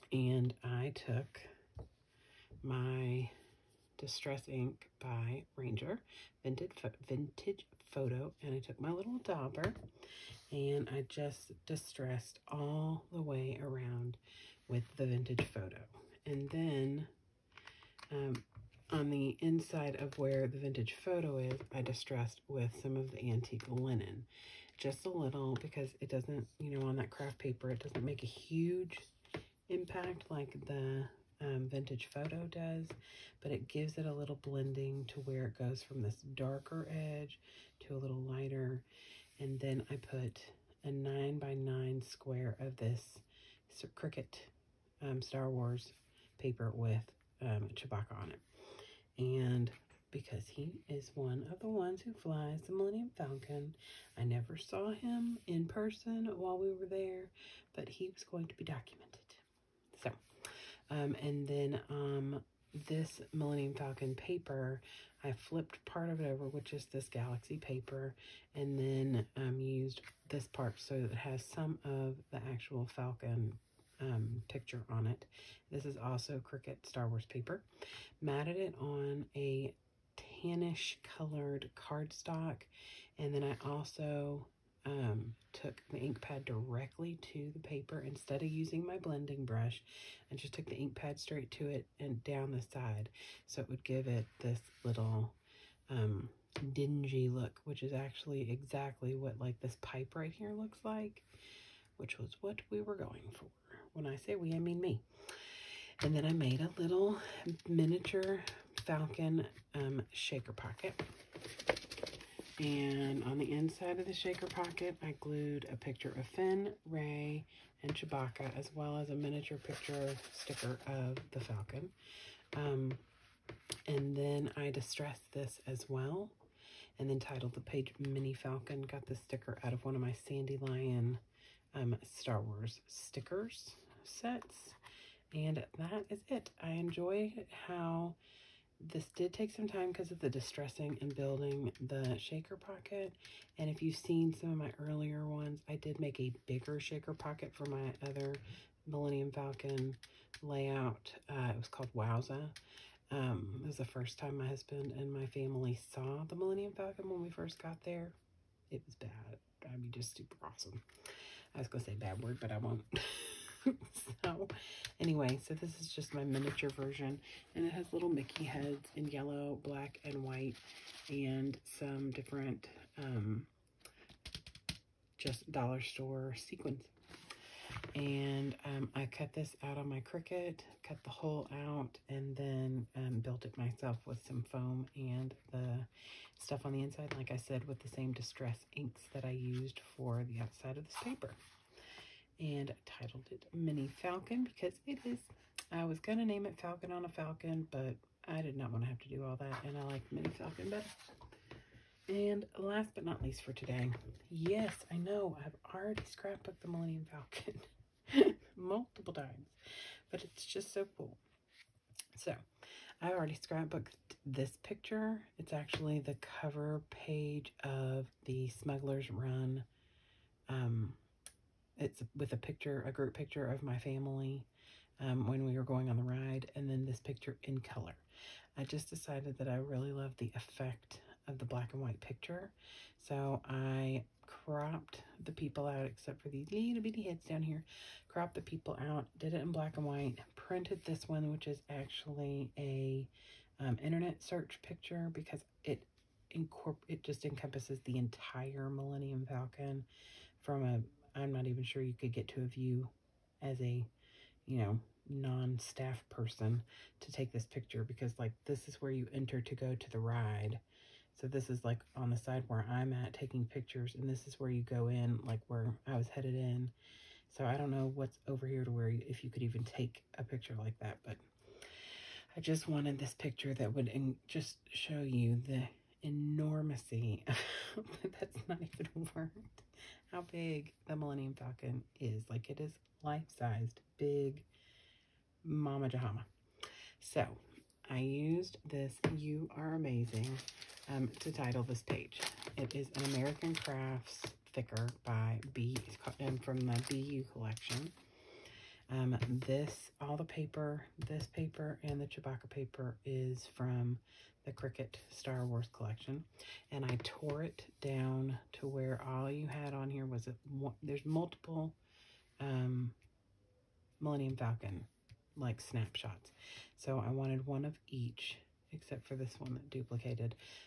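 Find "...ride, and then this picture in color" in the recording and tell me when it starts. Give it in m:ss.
3:46.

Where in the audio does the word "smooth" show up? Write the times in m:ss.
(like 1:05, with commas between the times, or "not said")
not said.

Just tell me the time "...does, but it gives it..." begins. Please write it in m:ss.
0:32.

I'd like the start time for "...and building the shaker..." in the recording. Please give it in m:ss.
2:21.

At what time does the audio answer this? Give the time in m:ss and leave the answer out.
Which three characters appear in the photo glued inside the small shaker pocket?
1:56.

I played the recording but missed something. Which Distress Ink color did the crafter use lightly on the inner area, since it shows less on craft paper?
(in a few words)
Antique Linen.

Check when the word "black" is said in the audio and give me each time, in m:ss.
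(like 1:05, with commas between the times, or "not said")
2:49, 3:51, 3:59.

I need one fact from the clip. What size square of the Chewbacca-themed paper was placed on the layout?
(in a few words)
9 by 9.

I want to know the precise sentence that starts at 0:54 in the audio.
I never saw him in person while we were there, but he was going to be documented.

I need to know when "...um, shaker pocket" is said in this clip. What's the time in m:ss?
1:49.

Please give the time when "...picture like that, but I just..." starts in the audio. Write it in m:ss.
4:30.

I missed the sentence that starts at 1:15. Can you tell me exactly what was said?
This is also Cricut Star Wars paper.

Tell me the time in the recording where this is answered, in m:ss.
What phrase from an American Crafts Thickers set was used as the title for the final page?
4:49.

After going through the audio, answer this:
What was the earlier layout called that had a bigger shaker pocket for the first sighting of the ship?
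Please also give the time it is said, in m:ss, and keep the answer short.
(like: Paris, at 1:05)
Wowza, at 2:31.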